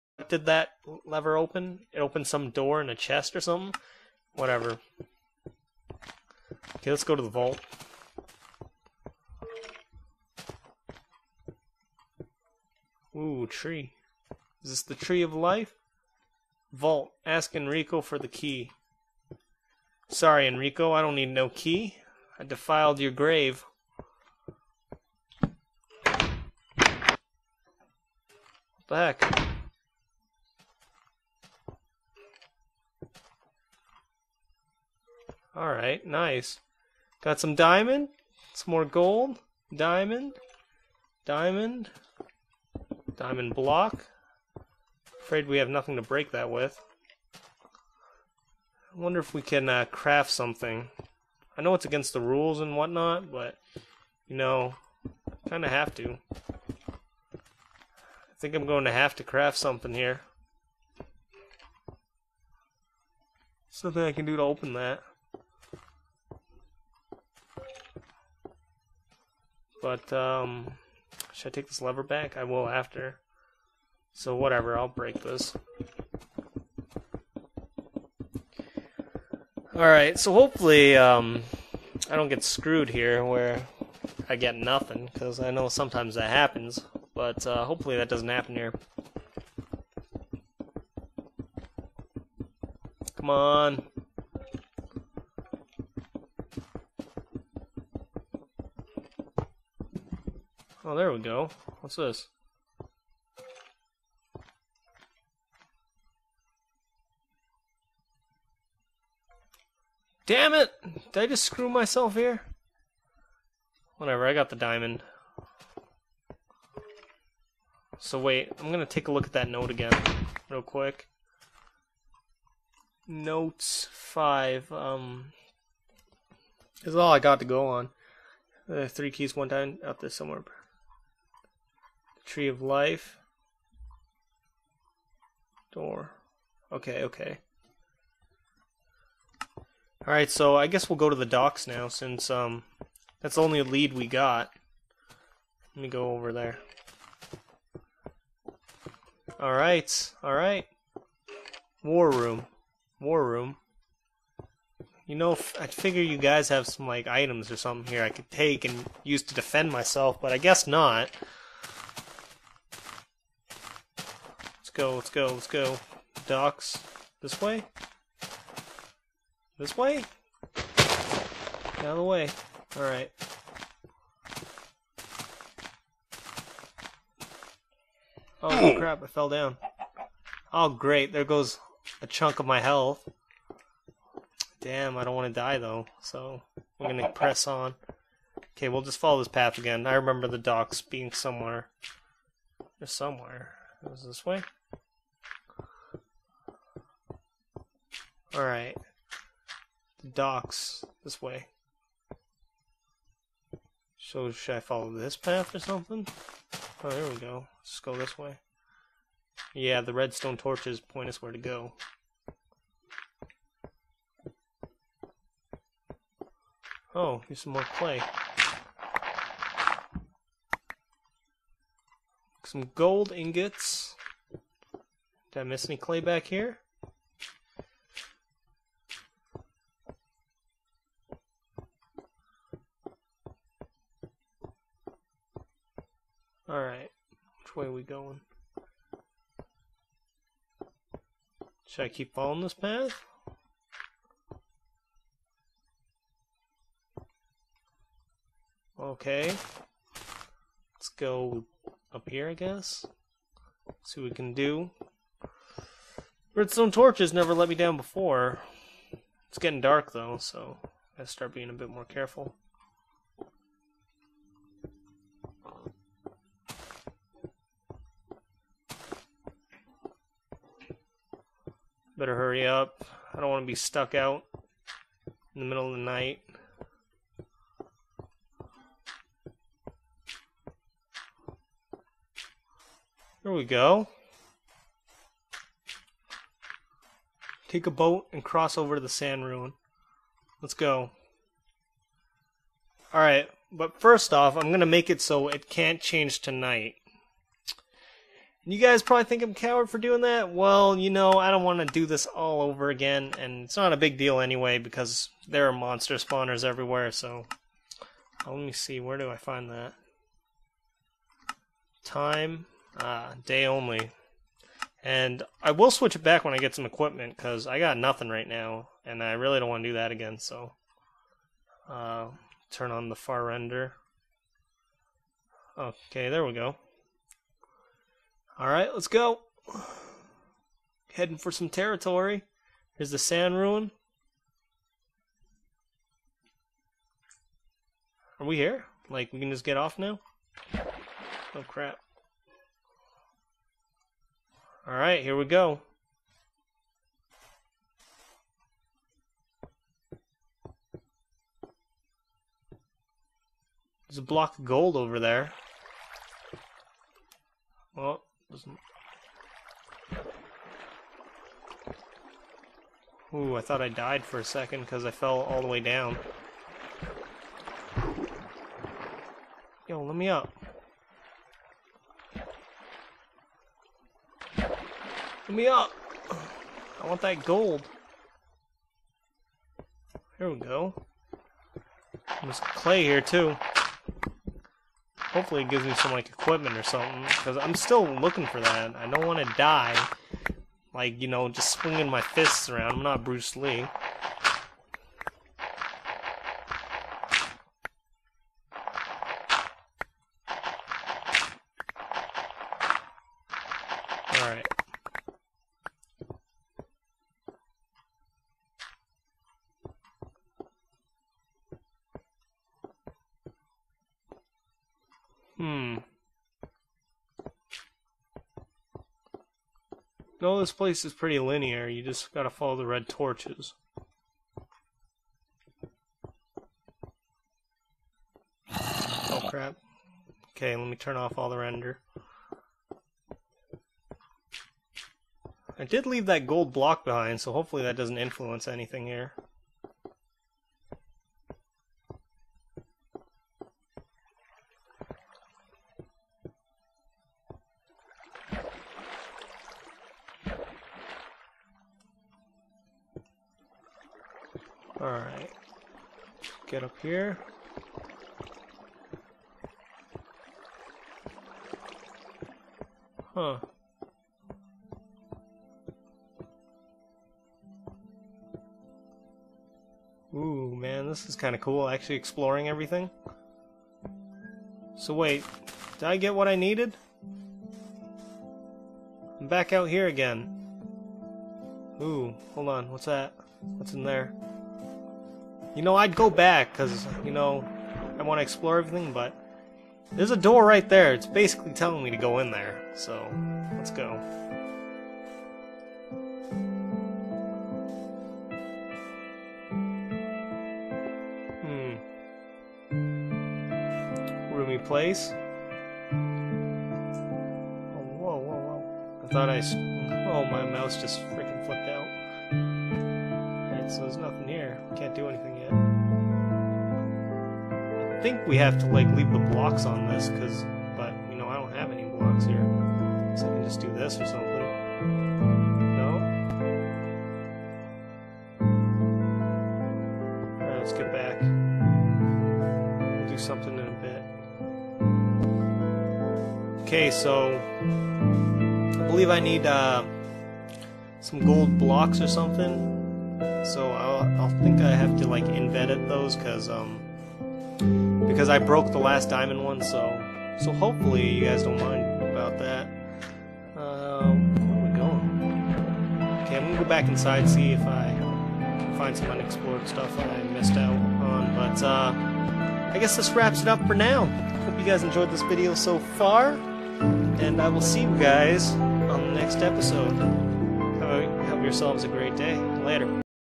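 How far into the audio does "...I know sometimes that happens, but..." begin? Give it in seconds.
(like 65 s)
85 s.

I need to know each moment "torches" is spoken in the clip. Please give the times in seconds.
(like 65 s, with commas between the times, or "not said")
210 s, 256 s, 422 s.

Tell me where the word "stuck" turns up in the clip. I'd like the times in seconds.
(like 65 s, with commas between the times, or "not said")
273 s.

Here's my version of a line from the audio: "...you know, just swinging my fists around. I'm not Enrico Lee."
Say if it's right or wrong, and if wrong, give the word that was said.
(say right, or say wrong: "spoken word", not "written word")
wrong: "Bruce", not "Enrico".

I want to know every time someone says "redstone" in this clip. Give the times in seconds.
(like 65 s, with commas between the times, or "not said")
209 s, 256 s.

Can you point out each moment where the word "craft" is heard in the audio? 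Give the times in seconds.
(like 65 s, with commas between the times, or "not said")
49 s, 59 s.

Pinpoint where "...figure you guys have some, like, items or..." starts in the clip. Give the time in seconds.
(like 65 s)
155 s.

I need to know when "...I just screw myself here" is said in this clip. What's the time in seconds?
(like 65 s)
111 s.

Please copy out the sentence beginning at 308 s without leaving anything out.
Let me see, where do I find that?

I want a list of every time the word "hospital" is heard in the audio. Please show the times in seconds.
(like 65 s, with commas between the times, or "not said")
not said.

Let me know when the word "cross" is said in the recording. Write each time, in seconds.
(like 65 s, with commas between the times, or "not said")
288 s.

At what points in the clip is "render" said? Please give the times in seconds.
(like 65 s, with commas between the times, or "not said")
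323 s, 431 s.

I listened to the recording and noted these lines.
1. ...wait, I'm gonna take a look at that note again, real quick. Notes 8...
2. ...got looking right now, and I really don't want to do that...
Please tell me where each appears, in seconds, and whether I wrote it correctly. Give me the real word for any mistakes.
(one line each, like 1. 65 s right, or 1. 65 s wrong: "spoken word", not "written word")
1. 118 s wrong: "5", not "8"
2. 317 s wrong: "nothing", not "looking".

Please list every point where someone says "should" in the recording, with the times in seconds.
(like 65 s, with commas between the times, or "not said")
71 s, 204 s, 241 s.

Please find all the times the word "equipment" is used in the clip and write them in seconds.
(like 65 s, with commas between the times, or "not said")
316 s, 386 s.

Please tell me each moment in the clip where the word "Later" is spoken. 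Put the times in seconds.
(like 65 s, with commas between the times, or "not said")
572 s.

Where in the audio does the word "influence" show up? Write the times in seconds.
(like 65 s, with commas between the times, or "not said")
437 s.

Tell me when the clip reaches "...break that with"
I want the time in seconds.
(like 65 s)
46 s.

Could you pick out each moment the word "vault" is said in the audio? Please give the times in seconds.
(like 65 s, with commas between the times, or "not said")
7 s, 16 s.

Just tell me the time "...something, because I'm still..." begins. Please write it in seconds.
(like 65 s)
386 s.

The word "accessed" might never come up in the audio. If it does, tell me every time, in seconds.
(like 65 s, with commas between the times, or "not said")
not said.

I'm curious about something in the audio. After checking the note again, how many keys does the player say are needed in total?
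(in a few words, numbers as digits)
3.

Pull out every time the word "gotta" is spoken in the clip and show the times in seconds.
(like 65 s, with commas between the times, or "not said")
260 s, 422 s.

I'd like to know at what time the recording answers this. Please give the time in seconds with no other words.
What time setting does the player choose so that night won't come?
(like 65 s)
313 s.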